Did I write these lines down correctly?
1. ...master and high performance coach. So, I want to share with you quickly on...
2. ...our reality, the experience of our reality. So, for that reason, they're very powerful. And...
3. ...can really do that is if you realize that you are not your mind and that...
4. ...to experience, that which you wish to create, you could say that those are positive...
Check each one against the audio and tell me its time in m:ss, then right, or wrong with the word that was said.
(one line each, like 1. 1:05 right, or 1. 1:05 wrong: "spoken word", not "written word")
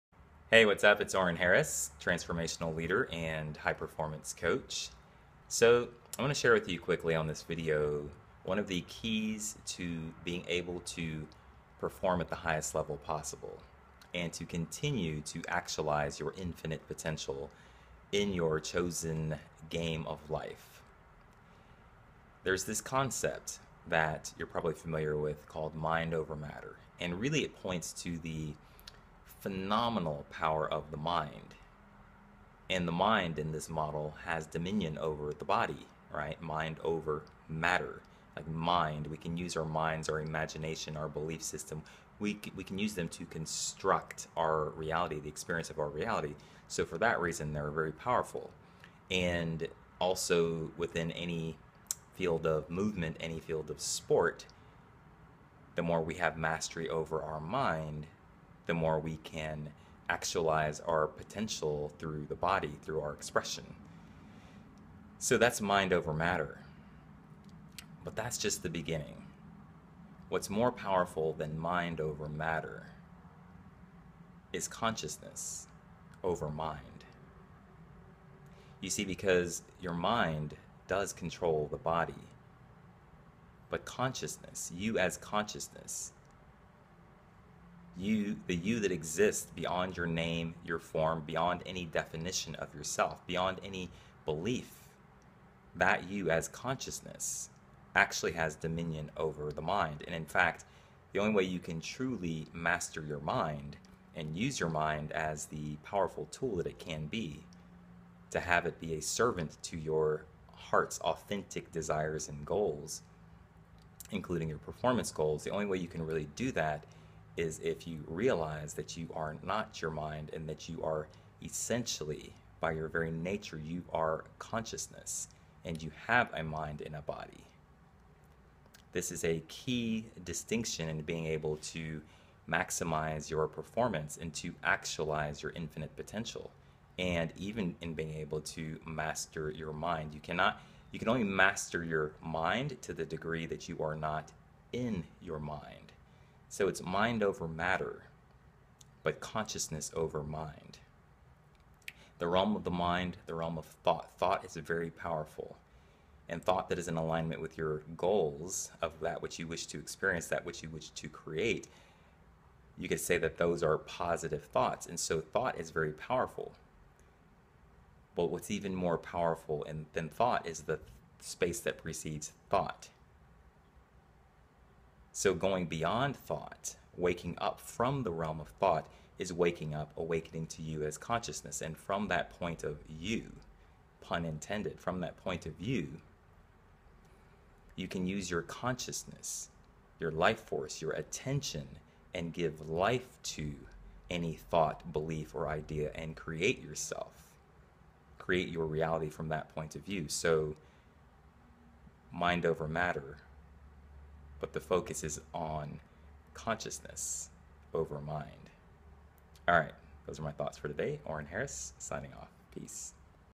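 1. 0:02 wrong: "leader", not "master"
2. 0:44 right
3. 1:55 right
4. 2:39 right.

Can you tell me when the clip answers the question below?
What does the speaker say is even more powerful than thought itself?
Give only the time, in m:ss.
2:50.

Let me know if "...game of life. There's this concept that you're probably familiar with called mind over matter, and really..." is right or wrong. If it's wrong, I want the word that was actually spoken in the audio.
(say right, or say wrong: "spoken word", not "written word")
right.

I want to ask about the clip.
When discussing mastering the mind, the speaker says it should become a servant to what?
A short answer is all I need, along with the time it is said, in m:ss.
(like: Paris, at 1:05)
Your heart's authentic desires, at 1:49.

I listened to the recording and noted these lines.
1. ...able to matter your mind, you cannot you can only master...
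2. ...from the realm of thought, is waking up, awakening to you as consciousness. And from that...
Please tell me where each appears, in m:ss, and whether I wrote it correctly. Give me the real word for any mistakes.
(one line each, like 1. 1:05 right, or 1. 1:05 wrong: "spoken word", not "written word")
1. 2:18 wrong: "master", not "matter"
2. 2:57 right.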